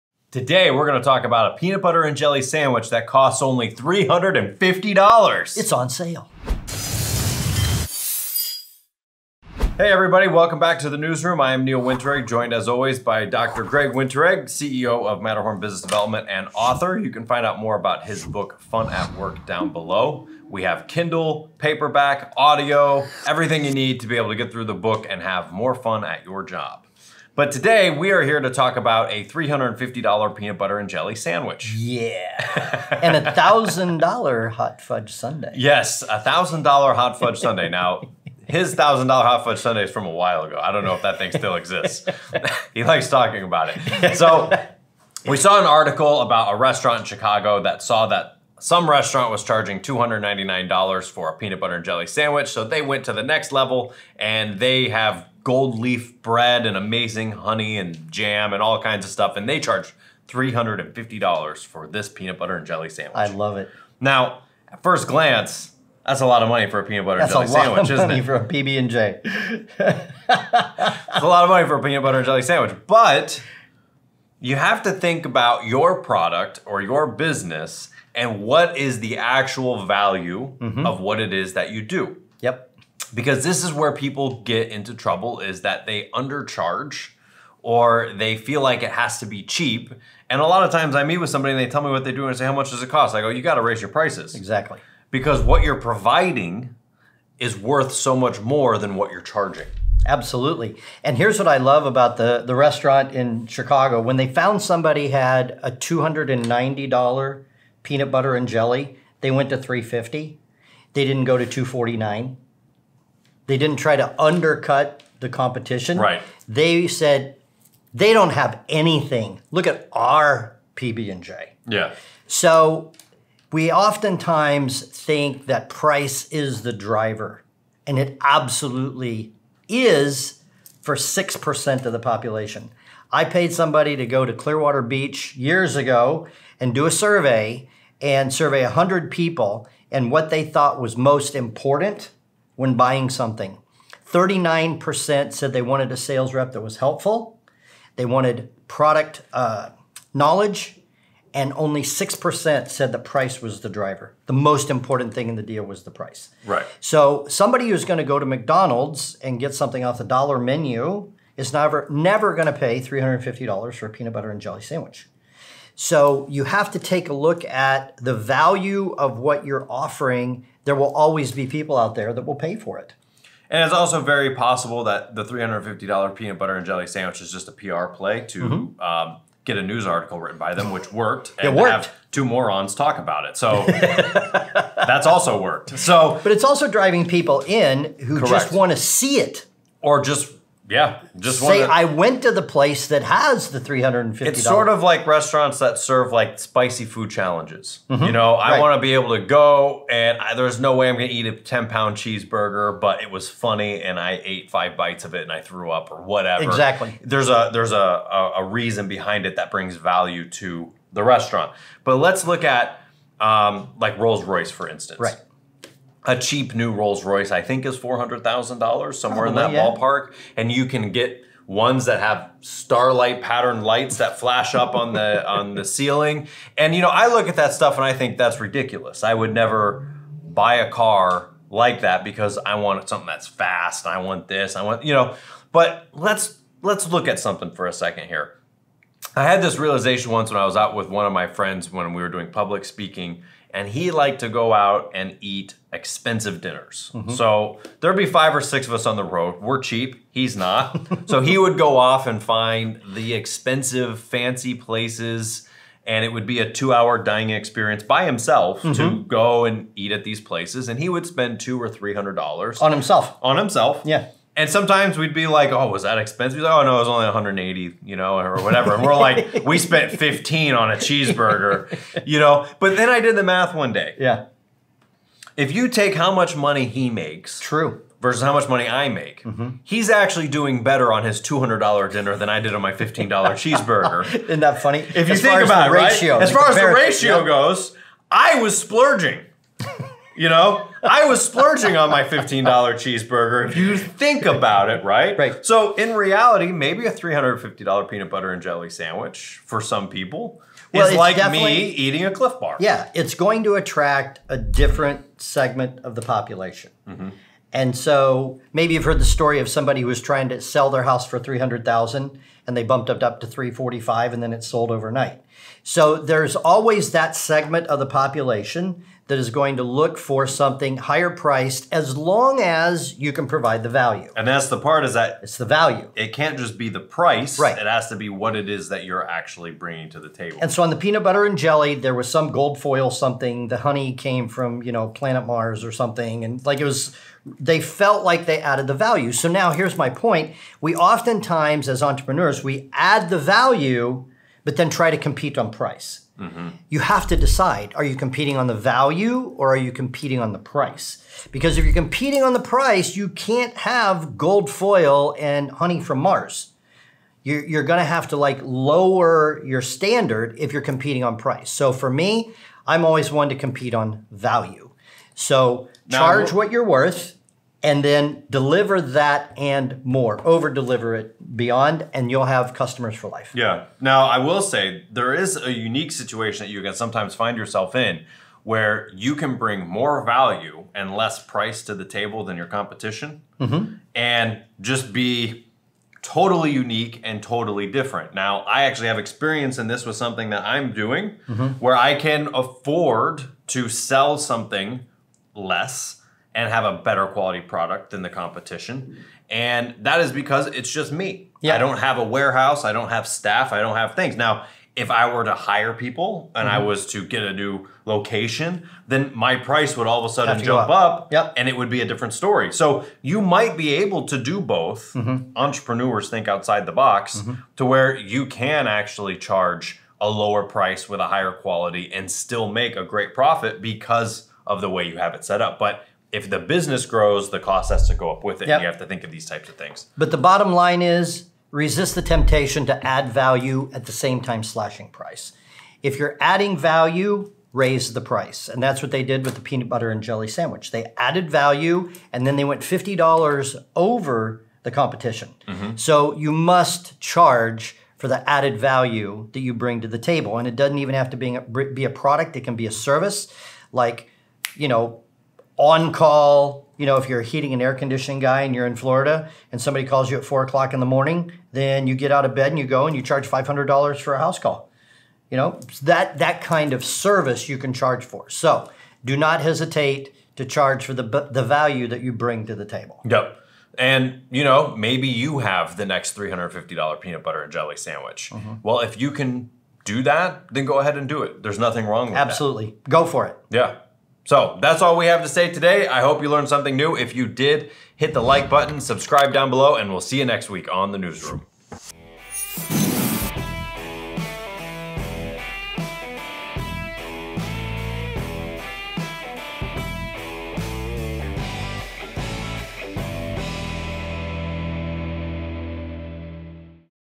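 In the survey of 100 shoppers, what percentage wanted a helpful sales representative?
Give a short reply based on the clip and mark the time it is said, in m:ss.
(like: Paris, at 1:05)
39%, at 2:24.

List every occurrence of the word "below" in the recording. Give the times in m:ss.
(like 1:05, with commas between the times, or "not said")
0:19, 8:09.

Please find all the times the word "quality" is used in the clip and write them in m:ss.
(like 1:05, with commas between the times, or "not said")
6:37, 7:01.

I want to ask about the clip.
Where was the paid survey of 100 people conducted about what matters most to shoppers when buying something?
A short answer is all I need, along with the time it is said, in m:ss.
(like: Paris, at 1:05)
Clearwater Beach, at 2:14.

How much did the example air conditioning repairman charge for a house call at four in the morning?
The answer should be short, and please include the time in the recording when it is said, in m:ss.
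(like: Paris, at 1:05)
$500, at 7:43.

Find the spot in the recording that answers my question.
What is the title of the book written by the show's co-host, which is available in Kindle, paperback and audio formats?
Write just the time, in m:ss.
0:18.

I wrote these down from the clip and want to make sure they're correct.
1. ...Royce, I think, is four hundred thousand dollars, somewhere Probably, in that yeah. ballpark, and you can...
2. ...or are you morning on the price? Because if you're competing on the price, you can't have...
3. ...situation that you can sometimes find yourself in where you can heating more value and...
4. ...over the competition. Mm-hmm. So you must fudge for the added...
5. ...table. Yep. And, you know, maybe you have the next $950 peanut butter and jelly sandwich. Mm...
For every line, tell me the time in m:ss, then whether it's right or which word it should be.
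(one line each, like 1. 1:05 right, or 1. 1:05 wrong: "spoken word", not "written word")
1. 3:37 right
2. 5:49 wrong: "competing", not "morning"
3. 6:15 wrong: "bring", not "heating"
4. 7:23 wrong: "charge", not "fudge"
5. 7:52 wrong: "350", not "950".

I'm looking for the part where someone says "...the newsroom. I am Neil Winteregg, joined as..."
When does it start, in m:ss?
0:10.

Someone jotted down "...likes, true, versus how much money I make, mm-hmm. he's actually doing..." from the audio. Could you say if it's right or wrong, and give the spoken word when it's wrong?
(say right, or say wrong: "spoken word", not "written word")
wrong: "makes", not "likes".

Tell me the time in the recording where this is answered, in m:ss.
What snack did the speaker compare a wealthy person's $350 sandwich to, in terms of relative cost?
5:02.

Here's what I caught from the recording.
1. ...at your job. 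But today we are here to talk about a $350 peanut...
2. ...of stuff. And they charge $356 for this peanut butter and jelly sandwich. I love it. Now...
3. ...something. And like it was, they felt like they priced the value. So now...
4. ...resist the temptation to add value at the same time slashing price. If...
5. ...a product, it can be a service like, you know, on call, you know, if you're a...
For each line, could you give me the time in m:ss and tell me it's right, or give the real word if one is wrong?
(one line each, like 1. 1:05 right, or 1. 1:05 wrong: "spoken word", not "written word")
1. 0:26 right
2. 0:59 wrong: "350", not "356"
3. 5:35 wrong: "added", not "priced"
4. 7:11 right
5. 7:31 right.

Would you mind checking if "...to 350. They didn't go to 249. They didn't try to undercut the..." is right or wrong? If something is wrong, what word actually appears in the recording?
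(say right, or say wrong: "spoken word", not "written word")
right.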